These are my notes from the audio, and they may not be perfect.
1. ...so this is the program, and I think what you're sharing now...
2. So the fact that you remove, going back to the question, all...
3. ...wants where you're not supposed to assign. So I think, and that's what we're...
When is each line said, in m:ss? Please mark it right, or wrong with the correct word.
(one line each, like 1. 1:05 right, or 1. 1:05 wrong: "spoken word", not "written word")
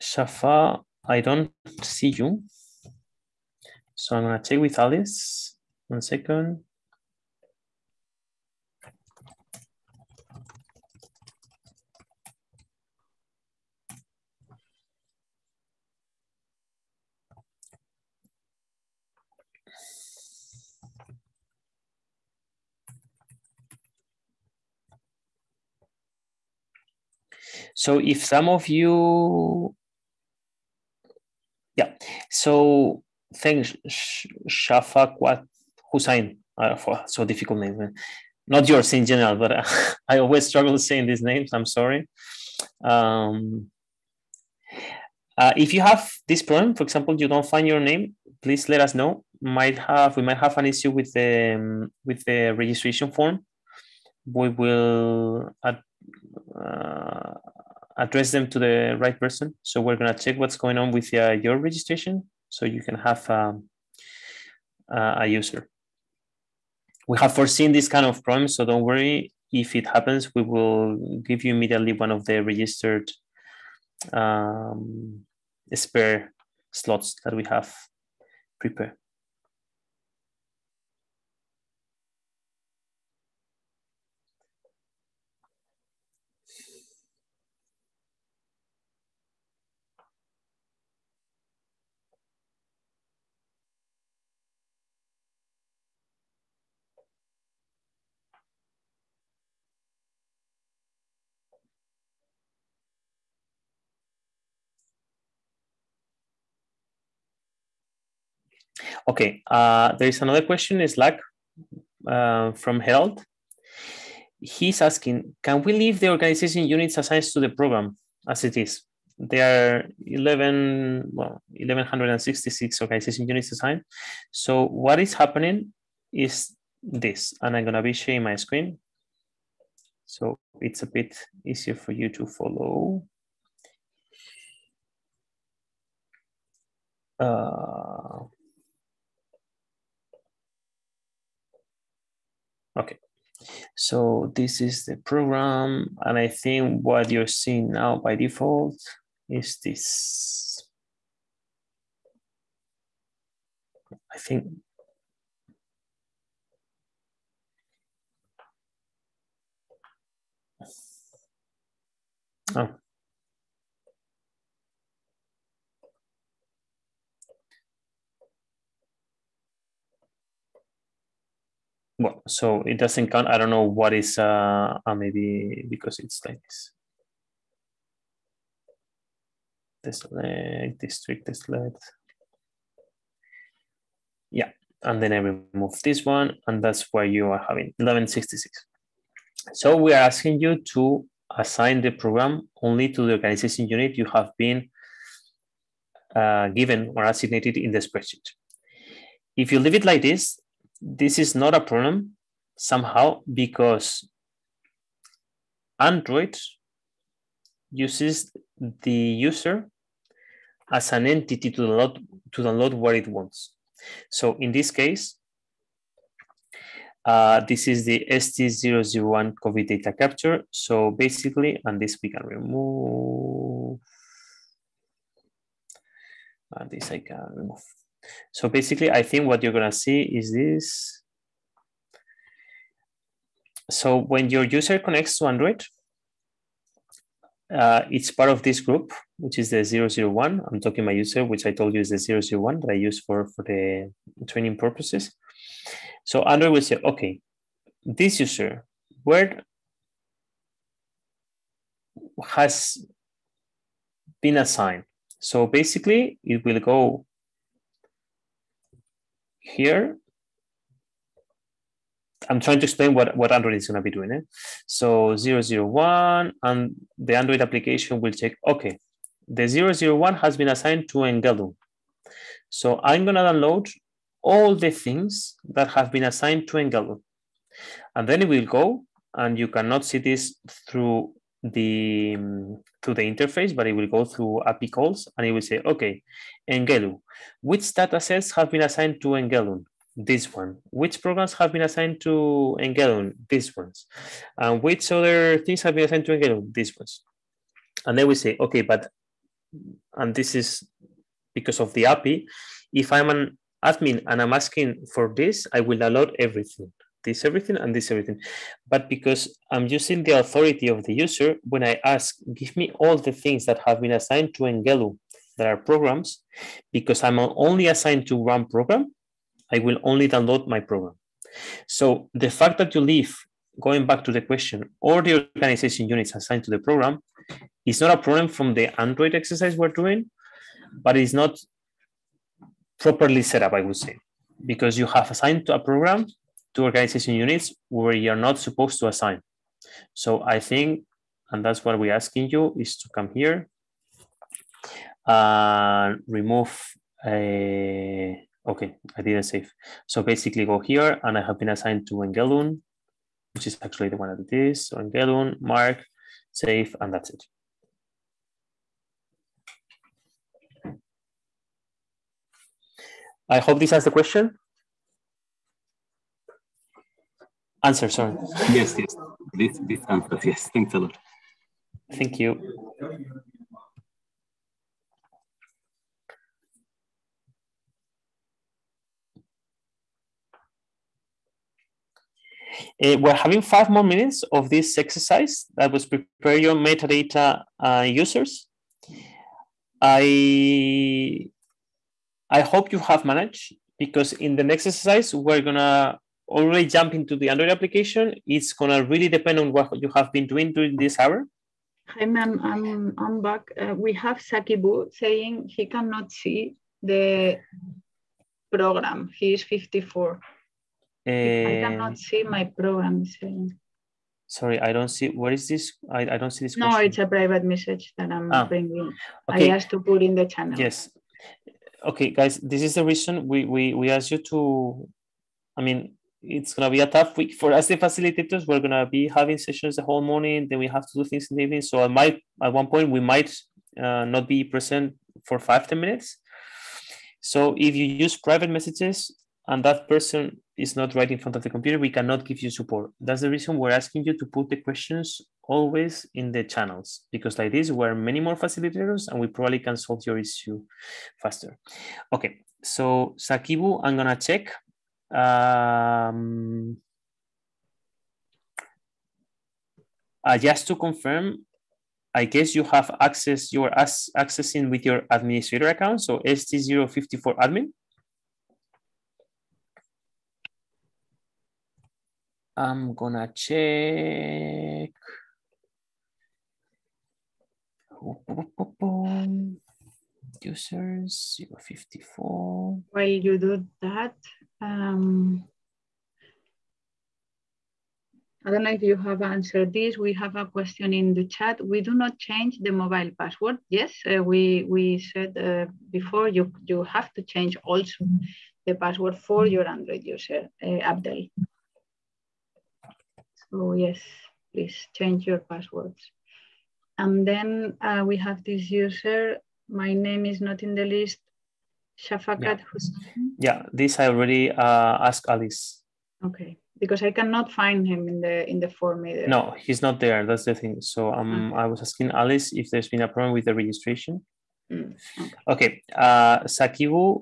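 1. 2:23 wrong: "seeing", not "sharing"
2. 5:21 wrong: "leave", not "remove"
3. 5:37 wrong: "units", not "wants".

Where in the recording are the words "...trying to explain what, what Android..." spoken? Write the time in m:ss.
4:22.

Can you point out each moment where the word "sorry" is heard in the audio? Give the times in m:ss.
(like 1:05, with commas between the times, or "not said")
0:41, 6:07, 6:54.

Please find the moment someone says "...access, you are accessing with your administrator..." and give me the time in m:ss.
7:42.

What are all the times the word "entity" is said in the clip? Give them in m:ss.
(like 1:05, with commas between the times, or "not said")
3:31.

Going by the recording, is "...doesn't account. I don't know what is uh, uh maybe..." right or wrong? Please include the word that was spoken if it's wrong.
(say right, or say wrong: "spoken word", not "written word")
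wrong: "count", not "account".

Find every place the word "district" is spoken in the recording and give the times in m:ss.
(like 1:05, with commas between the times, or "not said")
3:00.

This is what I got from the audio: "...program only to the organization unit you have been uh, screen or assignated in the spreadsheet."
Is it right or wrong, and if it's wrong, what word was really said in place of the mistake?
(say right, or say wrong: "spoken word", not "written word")
wrong: "given", not "screen".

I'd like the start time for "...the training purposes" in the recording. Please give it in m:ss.
4:03.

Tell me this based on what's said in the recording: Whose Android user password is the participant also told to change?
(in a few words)
Abdel.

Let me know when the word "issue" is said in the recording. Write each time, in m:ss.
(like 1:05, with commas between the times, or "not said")
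0:50, 7:30.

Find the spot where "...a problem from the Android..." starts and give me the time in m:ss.
5:27.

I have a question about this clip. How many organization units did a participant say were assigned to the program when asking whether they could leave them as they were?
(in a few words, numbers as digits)
1166.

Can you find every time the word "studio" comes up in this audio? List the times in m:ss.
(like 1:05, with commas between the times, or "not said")
not said.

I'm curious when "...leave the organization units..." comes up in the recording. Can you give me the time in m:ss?
1:55.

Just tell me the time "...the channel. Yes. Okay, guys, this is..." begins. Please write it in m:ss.
7:00.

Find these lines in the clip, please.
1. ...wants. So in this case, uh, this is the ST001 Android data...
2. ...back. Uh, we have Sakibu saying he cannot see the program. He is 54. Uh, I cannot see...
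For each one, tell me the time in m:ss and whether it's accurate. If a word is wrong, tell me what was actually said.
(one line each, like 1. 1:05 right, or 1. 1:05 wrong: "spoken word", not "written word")
1. 3:33 wrong: "COVID", not "Android"
2. 6:43 right.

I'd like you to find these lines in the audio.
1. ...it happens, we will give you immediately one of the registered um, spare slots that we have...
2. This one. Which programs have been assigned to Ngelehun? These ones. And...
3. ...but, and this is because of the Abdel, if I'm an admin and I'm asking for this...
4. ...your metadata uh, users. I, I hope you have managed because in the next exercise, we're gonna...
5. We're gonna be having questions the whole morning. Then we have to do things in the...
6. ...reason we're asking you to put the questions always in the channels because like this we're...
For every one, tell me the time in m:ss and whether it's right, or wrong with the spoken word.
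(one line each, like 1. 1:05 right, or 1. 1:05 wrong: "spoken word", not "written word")
1. 1:09 right
2. 4:49 right
3. 4:58 wrong: "API", not "Abdel"
4. 6:26 right
5. 7:08 wrong: "sessions", not "questions"
6. 7:23 right.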